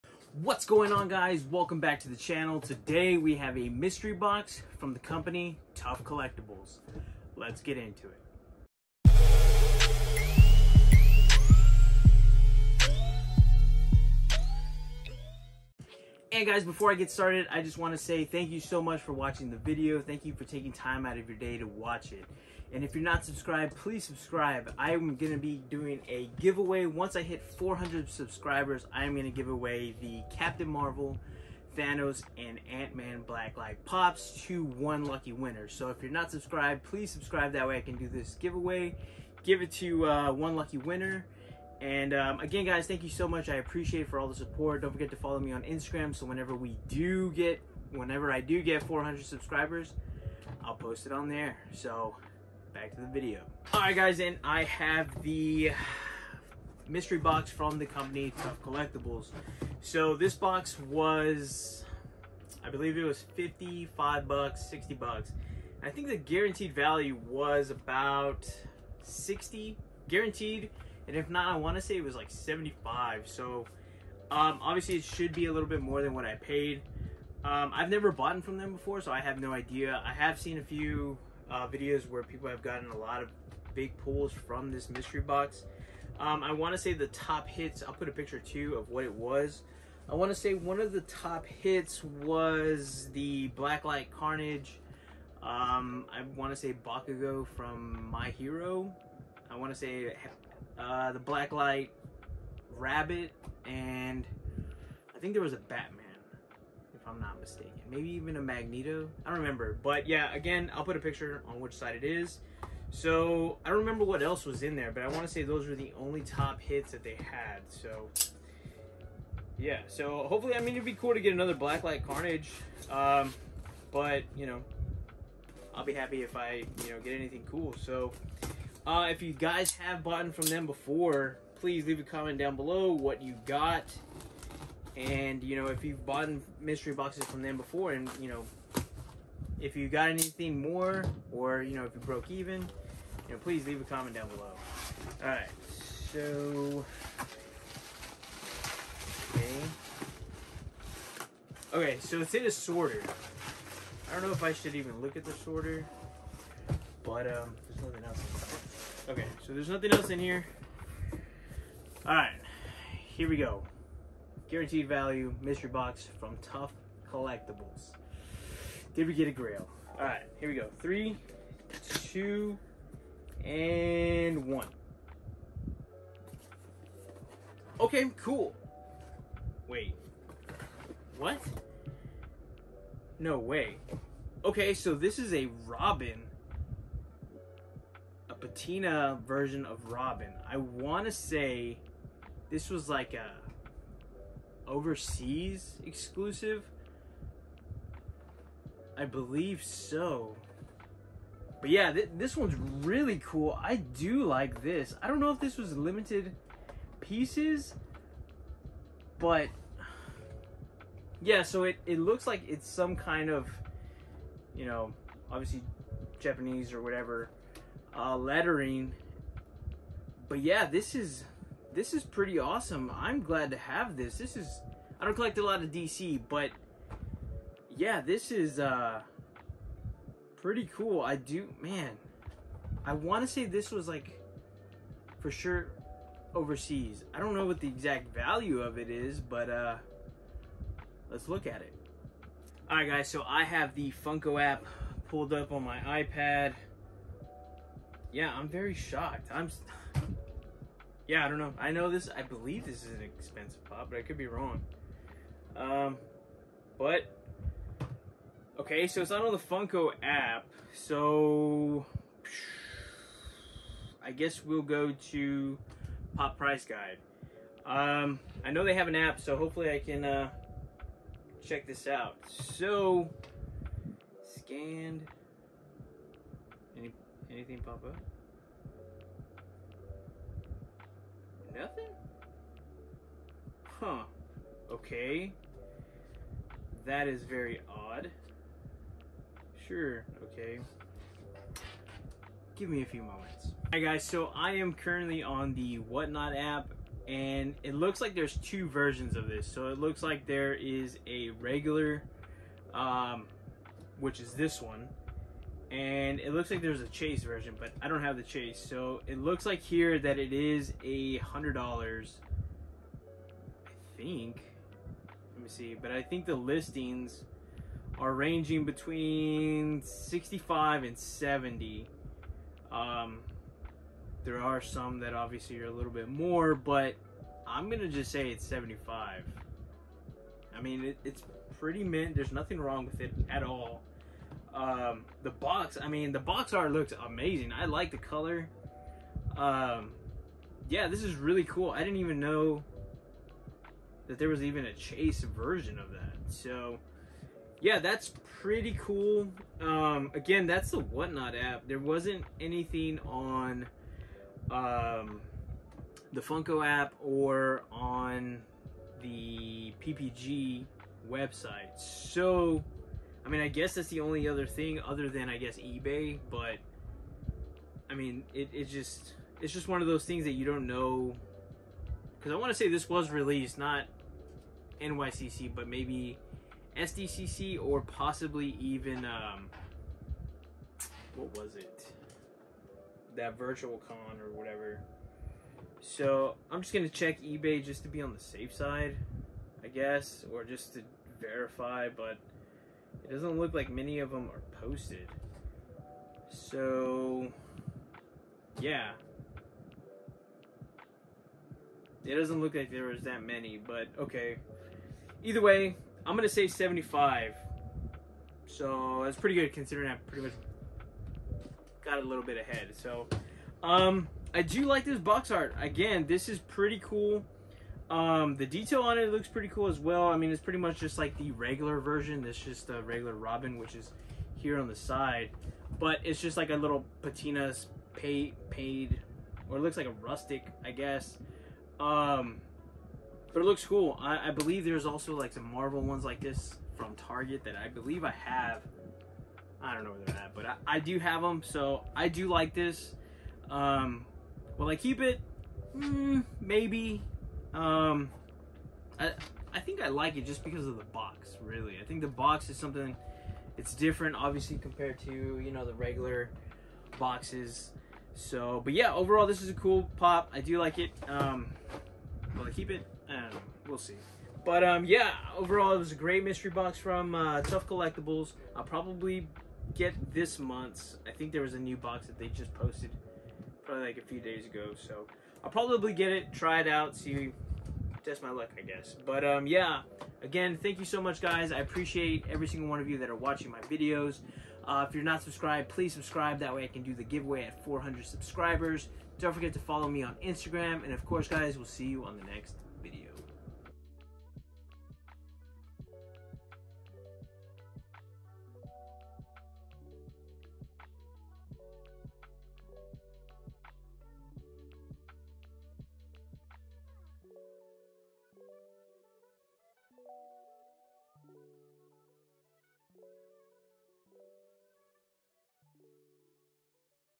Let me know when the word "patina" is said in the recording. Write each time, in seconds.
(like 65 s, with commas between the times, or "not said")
188 s, 427 s.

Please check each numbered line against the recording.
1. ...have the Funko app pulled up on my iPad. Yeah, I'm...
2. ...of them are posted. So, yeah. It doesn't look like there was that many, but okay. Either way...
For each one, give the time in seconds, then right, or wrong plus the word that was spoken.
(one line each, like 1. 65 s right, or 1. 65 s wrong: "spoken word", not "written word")
1. 243 s right
2. 393 s right.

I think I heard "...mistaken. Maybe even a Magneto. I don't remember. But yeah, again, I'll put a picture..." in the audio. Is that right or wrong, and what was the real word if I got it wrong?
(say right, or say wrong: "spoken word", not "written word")
right.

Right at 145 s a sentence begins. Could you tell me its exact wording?
All right, so okay, okay, so it's in a sorter.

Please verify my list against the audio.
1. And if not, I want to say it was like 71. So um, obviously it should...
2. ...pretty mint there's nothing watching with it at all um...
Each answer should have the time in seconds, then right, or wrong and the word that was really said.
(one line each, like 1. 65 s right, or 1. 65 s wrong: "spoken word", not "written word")
1. 71 s wrong: "75", not "71"
2. 331 s wrong: "wrong", not "watching".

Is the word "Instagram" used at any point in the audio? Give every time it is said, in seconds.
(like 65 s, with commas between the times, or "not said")
45 s, 490 s.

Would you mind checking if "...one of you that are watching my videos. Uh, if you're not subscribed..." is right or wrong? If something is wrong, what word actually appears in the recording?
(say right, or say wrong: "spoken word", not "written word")
right.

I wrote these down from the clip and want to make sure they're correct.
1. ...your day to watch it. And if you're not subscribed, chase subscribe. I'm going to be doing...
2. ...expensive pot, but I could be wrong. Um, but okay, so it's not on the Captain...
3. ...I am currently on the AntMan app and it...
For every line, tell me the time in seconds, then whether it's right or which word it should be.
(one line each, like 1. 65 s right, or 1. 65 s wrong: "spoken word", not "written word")
1. 21 s wrong: "please", not "chase"
2. 253 s wrong: "Funko", not "Captain"
3. 294 s wrong: "Whatnot", not "AntMan".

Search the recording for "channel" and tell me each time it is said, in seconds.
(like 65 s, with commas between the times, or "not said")
2 s.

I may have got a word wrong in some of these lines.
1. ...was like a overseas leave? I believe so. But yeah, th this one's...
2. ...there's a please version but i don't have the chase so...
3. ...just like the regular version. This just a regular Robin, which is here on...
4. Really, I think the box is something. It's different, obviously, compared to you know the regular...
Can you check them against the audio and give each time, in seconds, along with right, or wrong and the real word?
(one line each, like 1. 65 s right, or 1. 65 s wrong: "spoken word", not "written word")
1. 192 s wrong: "exclusive", not "leave"
2. 306 s wrong: "chase", not "please"
3. 420 s right
4. 451 s right.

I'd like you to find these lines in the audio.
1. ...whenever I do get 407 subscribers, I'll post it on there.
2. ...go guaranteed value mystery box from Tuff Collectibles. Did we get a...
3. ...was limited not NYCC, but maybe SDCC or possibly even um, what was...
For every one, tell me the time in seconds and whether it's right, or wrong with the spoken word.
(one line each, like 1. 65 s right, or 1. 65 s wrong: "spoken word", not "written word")
1. 47 s wrong: "400", not "407"
2. 163 s right
3. 372 s wrong: "released", not "limited".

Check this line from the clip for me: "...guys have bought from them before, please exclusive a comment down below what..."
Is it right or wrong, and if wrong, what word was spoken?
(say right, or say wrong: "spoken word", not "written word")
wrong: "leave", not "exclusive".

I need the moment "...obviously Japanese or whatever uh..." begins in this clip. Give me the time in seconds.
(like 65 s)
215 s.